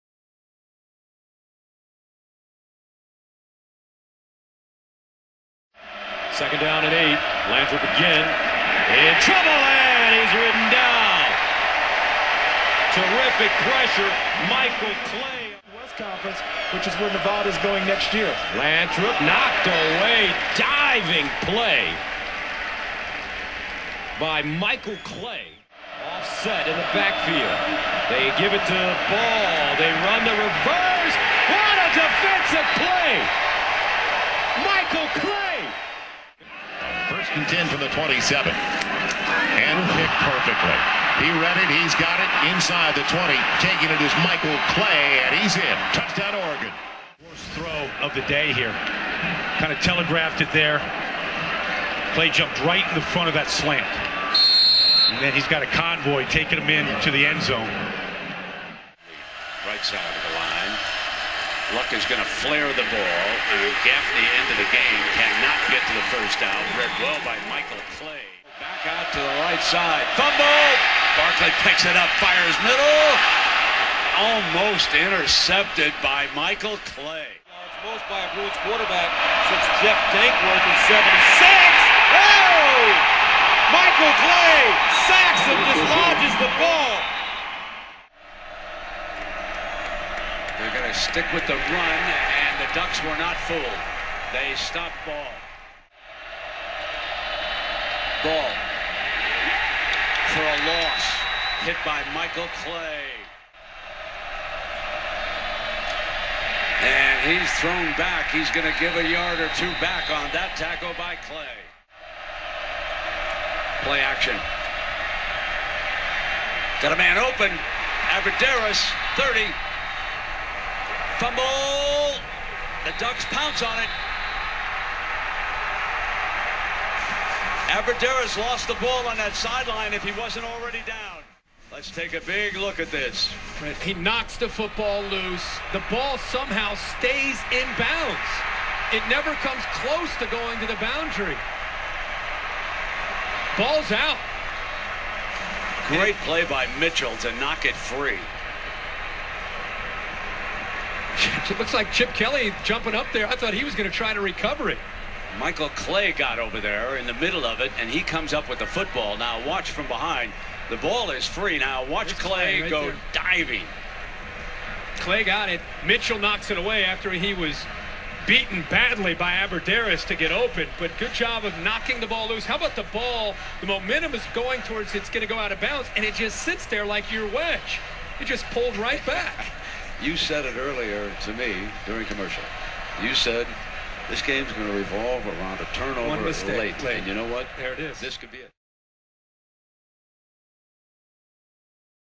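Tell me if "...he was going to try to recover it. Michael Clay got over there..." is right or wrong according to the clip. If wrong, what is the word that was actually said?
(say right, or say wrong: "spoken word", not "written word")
right.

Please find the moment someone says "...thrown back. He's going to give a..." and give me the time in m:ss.
1:47.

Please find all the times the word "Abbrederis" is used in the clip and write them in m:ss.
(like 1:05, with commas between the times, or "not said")
1:58, 2:07, 2:49.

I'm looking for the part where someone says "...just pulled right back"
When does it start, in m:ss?
2:58.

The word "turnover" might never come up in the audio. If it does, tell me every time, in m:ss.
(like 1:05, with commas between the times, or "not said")
3:05.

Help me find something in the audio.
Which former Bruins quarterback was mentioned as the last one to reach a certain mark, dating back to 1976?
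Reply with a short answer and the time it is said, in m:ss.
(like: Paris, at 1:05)
Jeff Dankworth, at 1:19.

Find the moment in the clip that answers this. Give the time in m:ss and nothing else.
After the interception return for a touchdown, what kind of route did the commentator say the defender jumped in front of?
0:53.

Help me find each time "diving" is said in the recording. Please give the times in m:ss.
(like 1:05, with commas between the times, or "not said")
0:20, 2:43.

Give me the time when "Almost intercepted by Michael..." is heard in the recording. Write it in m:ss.
1:14.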